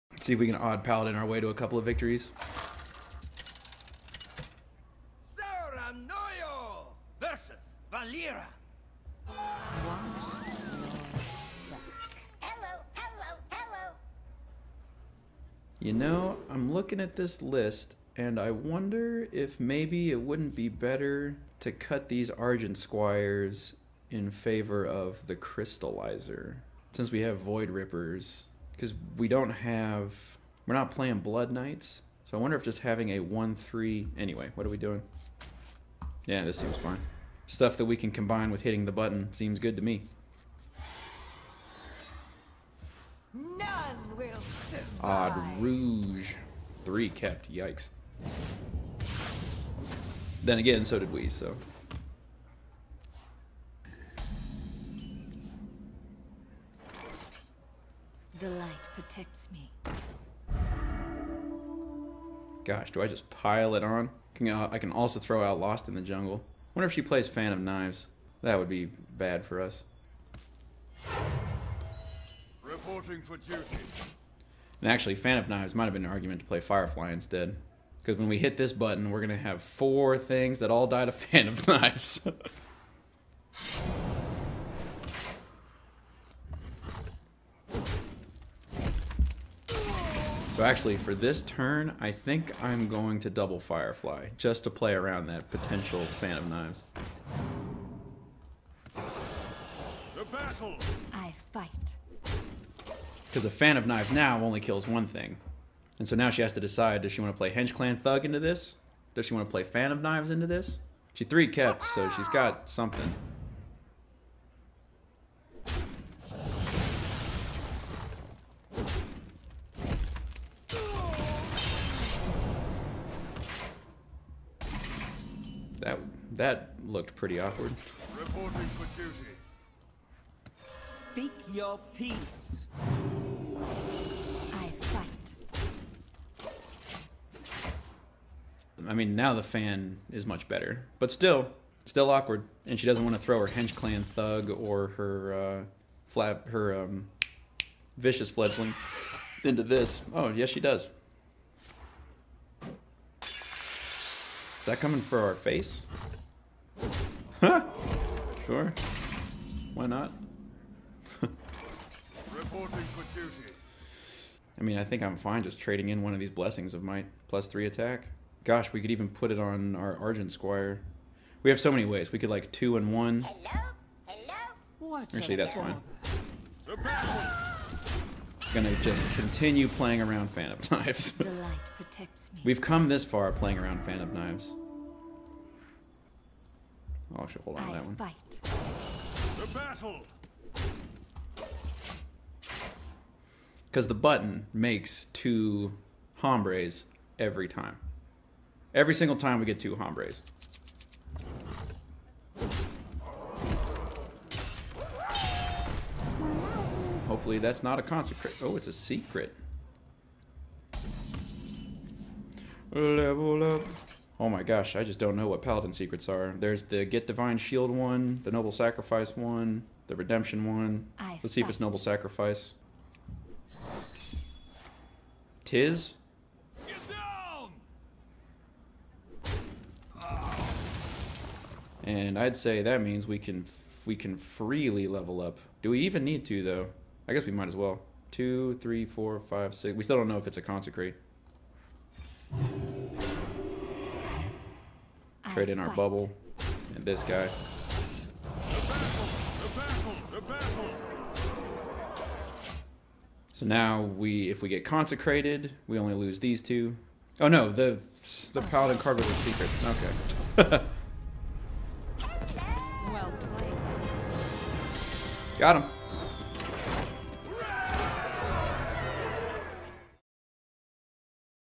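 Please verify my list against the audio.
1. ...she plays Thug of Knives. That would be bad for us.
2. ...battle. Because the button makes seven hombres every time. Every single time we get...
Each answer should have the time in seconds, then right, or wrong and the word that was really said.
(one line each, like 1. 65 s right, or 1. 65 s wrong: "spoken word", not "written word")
1. 66 s wrong: "Fan", not "Thug"
2. 189 s wrong: "two", not "seven".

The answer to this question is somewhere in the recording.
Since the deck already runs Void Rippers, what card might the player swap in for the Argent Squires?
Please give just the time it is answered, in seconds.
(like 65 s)
25 s.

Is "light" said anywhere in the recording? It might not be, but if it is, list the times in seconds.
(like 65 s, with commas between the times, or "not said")
58 s, 181 s.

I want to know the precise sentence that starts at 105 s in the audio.
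And so now she has to decide, does she want to play Hench Clan Thug into this?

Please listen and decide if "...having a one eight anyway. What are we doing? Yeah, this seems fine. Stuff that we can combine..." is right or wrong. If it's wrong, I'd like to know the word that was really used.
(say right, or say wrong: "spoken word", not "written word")
wrong: "three", not "eight".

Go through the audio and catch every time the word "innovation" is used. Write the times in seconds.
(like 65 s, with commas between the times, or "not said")
not said.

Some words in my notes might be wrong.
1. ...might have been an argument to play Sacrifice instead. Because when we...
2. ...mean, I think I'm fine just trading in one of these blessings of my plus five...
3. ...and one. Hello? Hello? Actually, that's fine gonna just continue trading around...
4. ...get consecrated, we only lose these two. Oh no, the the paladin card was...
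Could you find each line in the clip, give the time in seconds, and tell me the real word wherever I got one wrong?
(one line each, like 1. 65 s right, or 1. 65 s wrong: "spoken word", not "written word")
1. 75 s wrong: "Firefly", not "Sacrifice"
2. 164 s wrong: "three", not "five"
3. 172 s wrong: "playing", not "trading"
4. 254 s right.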